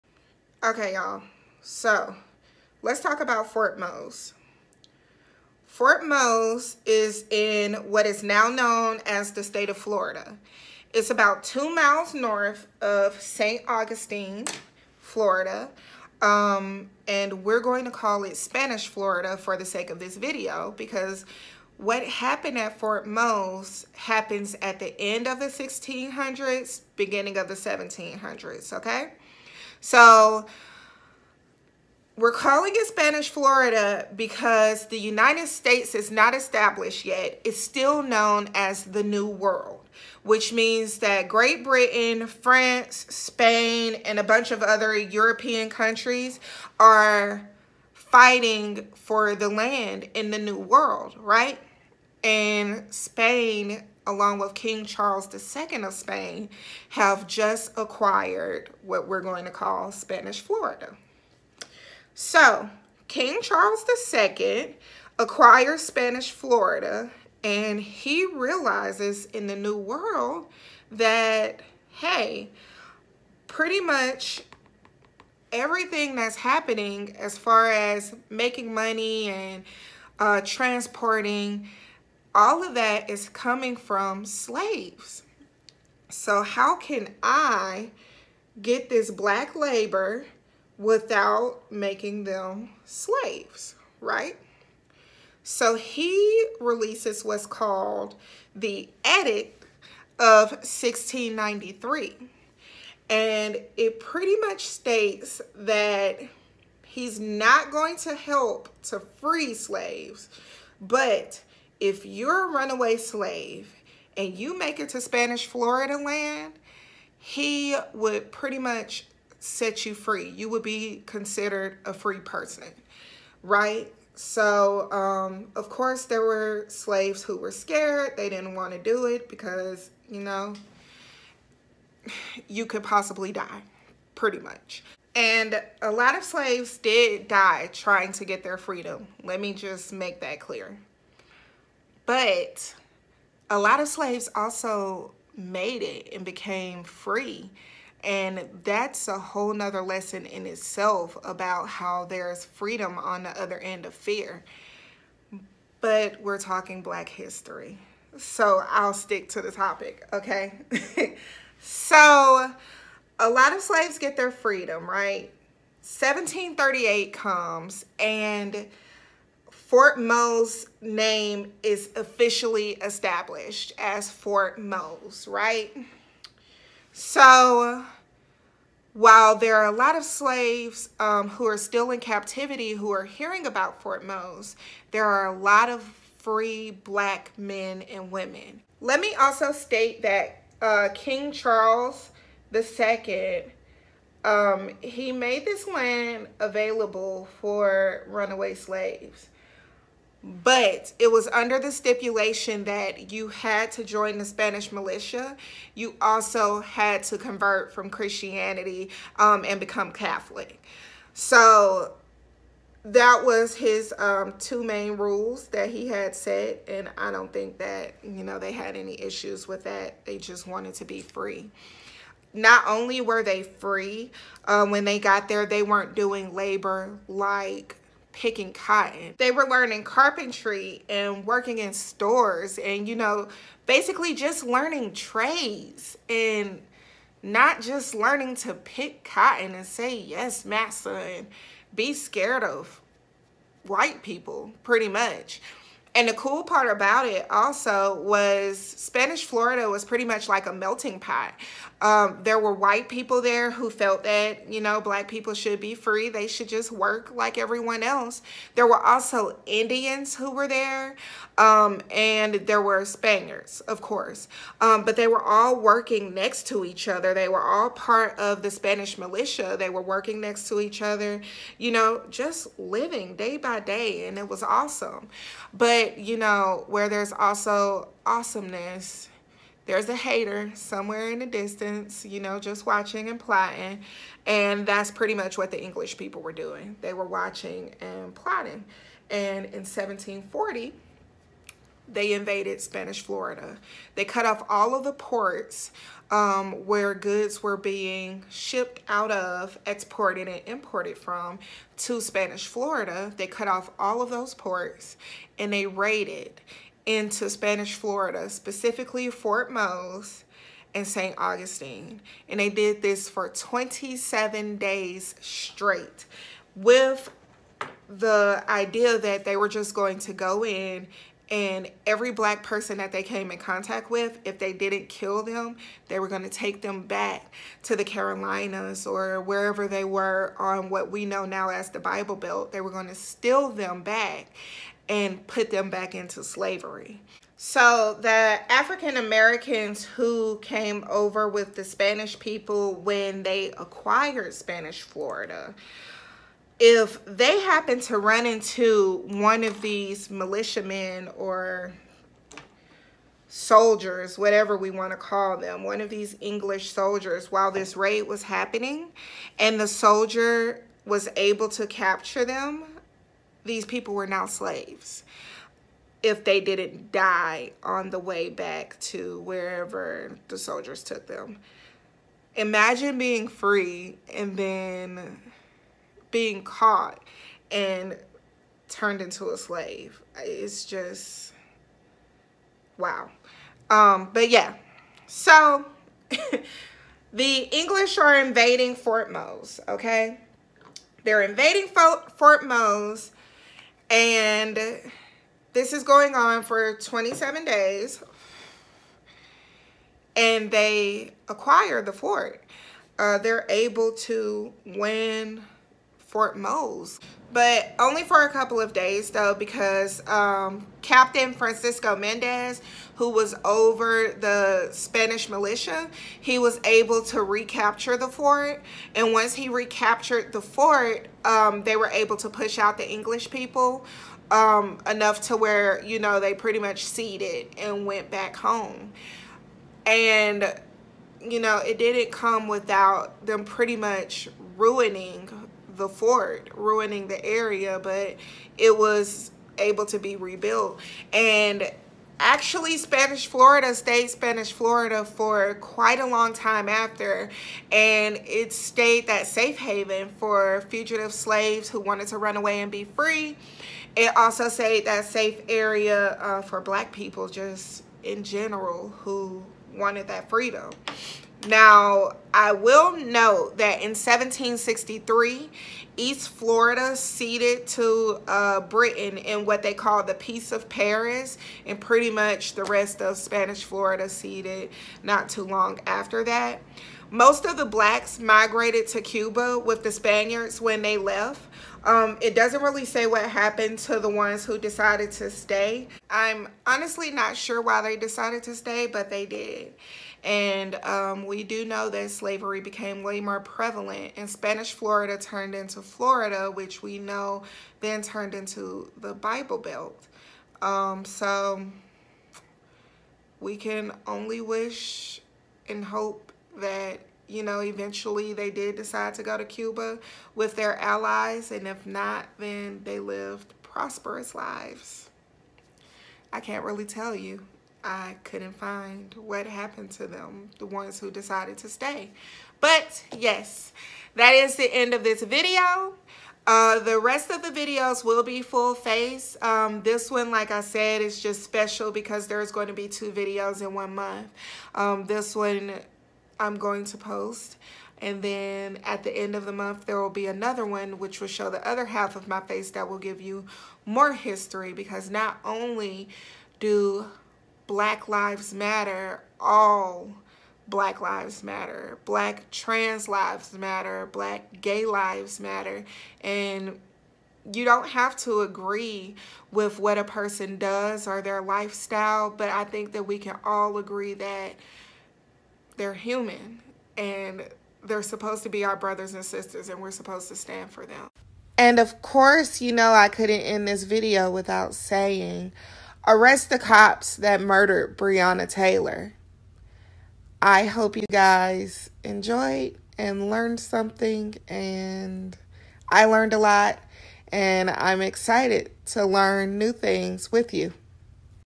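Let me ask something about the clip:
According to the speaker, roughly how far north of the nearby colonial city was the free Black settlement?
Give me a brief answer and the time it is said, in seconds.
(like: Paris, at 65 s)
2 miles, at 11 s.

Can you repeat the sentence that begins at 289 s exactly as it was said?
And in 1740, they invaded Spanish Florida.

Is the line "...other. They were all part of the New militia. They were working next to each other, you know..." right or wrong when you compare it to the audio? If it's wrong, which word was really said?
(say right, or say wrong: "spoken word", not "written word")
wrong: "Spanish", not "New".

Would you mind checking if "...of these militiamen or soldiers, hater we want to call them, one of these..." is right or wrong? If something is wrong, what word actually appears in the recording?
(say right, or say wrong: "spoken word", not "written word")
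wrong: "whatever", not "hater".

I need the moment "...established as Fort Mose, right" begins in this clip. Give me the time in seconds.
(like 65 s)
172 s.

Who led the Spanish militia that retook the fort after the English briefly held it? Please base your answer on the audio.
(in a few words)
Francisco Mendez.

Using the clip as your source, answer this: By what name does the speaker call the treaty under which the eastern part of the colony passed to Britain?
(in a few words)
Peace of Paris.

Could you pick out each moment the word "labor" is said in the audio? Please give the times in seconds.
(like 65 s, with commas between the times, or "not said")
89 s, 226 s.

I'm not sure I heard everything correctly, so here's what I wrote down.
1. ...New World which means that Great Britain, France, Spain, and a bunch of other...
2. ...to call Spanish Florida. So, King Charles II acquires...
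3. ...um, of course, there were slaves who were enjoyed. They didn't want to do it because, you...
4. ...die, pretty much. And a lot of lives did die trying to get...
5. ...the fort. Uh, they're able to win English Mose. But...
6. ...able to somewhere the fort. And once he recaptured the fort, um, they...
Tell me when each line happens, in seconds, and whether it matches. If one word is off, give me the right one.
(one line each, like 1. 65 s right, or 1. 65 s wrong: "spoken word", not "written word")
1. 39 s right
2. 59 s right
3. 124 s wrong: "scared", not "enjoyed"
4. 133 s wrong: "slaves", not "lives"
5. 401 s wrong: "Fort", not "English"
6. 416 s wrong: "recapture", not "somewhere".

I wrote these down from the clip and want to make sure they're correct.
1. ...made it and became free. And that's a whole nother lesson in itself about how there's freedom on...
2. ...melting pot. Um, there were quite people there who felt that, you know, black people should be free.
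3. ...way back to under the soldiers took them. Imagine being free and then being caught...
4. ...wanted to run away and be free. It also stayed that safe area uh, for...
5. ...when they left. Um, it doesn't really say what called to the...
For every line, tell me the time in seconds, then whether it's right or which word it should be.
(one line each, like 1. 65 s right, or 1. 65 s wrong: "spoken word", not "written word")
1. 145 s right
2. 250 s wrong: "white", not "quite"
3. 367 s wrong: "wherever", not "under"
4. 451 s right
5. 480 s wrong: "happened", not "called".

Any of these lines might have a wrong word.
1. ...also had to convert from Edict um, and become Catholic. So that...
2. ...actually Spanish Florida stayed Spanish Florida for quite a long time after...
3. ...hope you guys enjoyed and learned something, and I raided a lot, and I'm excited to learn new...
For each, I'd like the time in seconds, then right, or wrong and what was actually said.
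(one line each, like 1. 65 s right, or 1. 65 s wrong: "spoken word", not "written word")
1. 205 s wrong: "Christianity", not "Edict"
2. 442 s right
3. 580 s wrong: "learned", not "raided".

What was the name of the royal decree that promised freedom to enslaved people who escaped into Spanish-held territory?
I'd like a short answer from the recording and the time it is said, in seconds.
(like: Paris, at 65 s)
Edict of 1693, at 99 s.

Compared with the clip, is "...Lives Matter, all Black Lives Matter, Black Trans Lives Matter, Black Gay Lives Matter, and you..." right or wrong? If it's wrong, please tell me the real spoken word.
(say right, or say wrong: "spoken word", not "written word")
right.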